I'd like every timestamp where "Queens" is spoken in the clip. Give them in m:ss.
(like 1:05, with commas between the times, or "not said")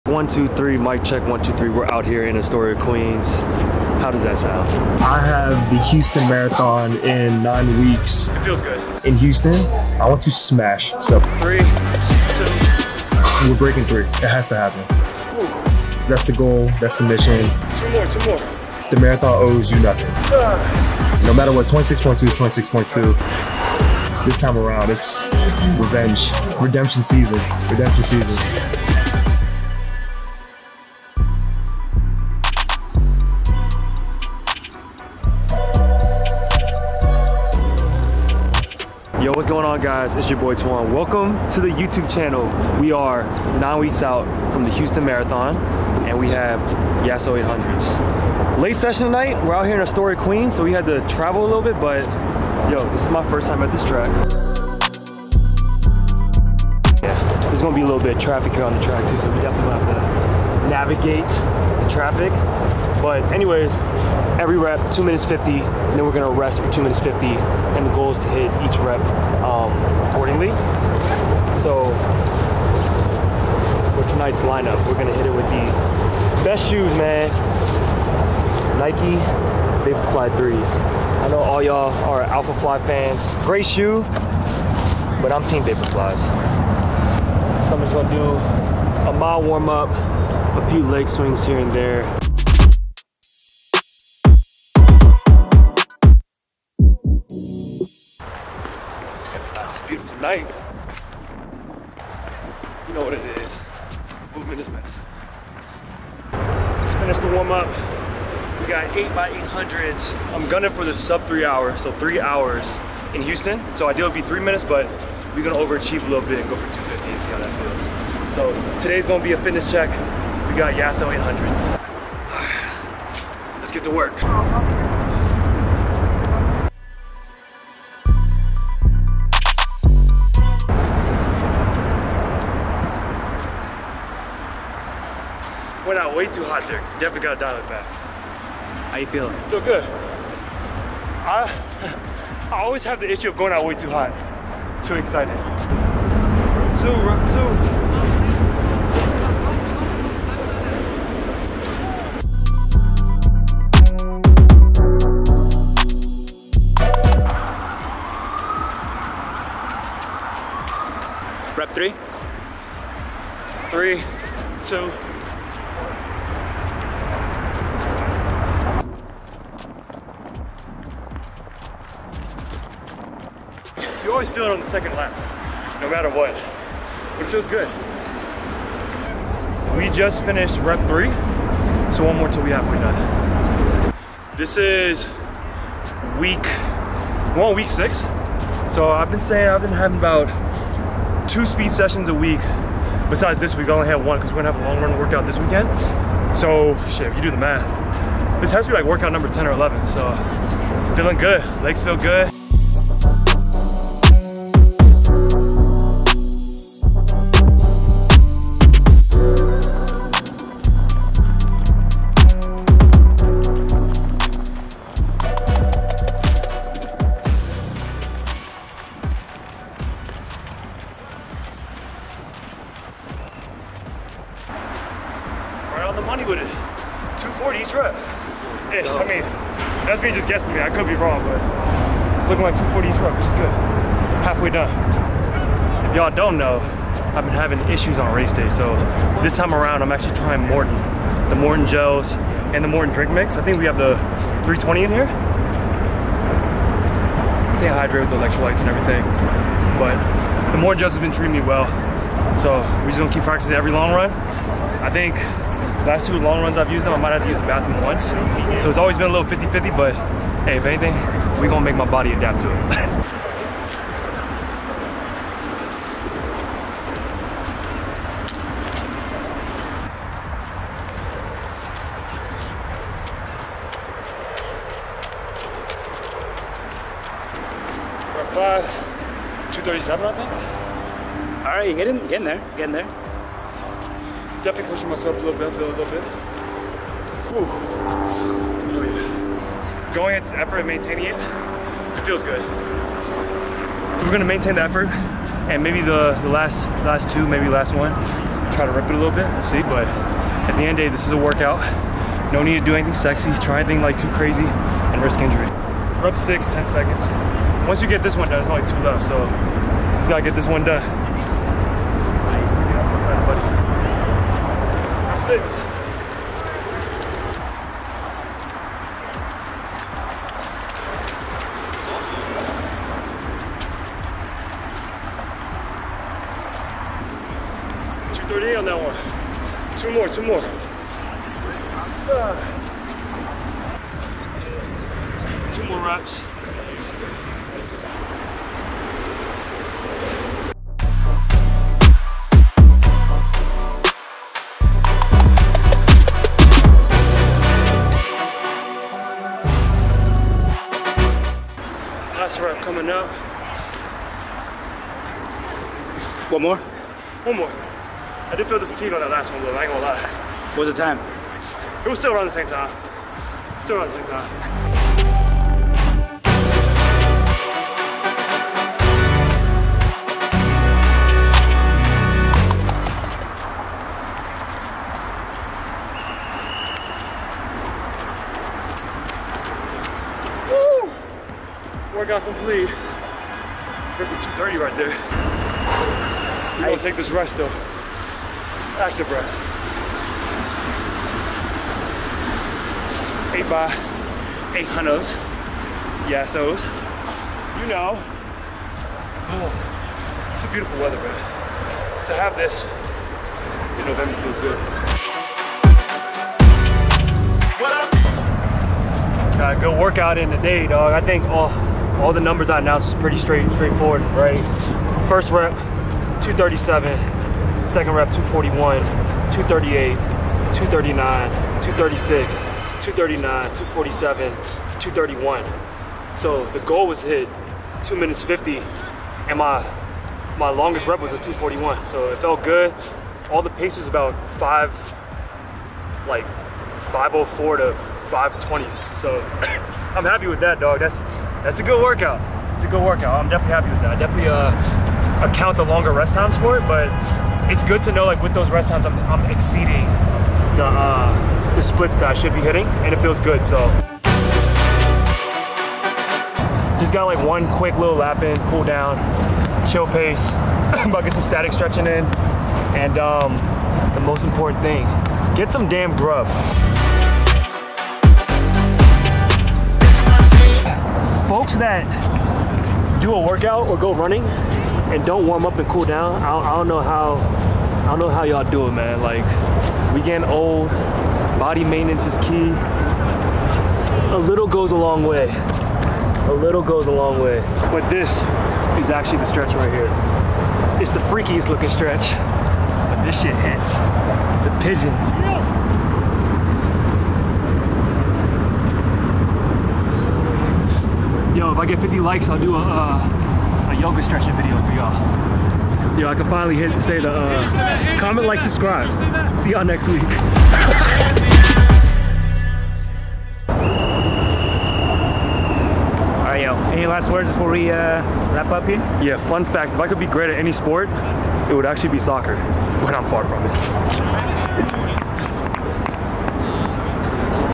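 0:02, 0:50.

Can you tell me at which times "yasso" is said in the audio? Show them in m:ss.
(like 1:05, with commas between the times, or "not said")
0:47, 2:00, 6:36.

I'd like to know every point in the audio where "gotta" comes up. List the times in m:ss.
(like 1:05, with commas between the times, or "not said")
5:10.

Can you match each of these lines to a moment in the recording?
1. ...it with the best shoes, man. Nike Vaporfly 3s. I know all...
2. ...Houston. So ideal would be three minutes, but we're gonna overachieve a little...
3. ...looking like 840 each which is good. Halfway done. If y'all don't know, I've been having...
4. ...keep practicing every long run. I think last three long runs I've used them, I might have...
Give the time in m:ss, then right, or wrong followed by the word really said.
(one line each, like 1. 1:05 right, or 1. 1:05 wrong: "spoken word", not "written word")
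1. 1:15 right
2. 1:53 right
3. 3:52 wrong: "240", not "840"
4. 4:13 wrong: "two", not "three".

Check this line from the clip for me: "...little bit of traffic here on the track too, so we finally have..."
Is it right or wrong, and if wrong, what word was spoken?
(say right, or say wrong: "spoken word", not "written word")
wrong: "definitely", not "finally".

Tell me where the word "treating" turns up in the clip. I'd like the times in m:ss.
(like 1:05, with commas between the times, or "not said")
4:11.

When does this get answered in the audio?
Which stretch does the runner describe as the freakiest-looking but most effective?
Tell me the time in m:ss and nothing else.
8:13.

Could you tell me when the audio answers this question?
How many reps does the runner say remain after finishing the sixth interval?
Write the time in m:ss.
5:08.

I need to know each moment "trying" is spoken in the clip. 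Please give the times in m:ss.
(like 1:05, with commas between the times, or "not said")
4:00.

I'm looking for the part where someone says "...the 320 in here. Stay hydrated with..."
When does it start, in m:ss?
4:03.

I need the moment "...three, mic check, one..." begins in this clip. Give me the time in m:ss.
0:00.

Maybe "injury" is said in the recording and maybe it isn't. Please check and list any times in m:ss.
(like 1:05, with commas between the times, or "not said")
5:05.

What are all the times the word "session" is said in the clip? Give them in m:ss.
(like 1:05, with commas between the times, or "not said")
0:48, 3:11.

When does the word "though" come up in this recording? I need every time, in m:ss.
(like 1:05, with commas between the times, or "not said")
6:27.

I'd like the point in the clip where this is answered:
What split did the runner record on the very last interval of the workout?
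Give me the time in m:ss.
7:04.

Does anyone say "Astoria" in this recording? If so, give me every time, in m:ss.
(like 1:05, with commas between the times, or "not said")
0:02, 0:49.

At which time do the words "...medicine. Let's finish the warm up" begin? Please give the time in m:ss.
1:44.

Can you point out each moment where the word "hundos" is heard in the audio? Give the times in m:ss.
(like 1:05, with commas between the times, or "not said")
6:34.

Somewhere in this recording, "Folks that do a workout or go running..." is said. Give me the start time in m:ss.
7:51.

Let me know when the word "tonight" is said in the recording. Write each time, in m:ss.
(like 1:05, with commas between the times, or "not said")
0:49, 1:14.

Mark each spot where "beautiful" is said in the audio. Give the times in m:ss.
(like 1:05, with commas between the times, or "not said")
1:39, 6:40.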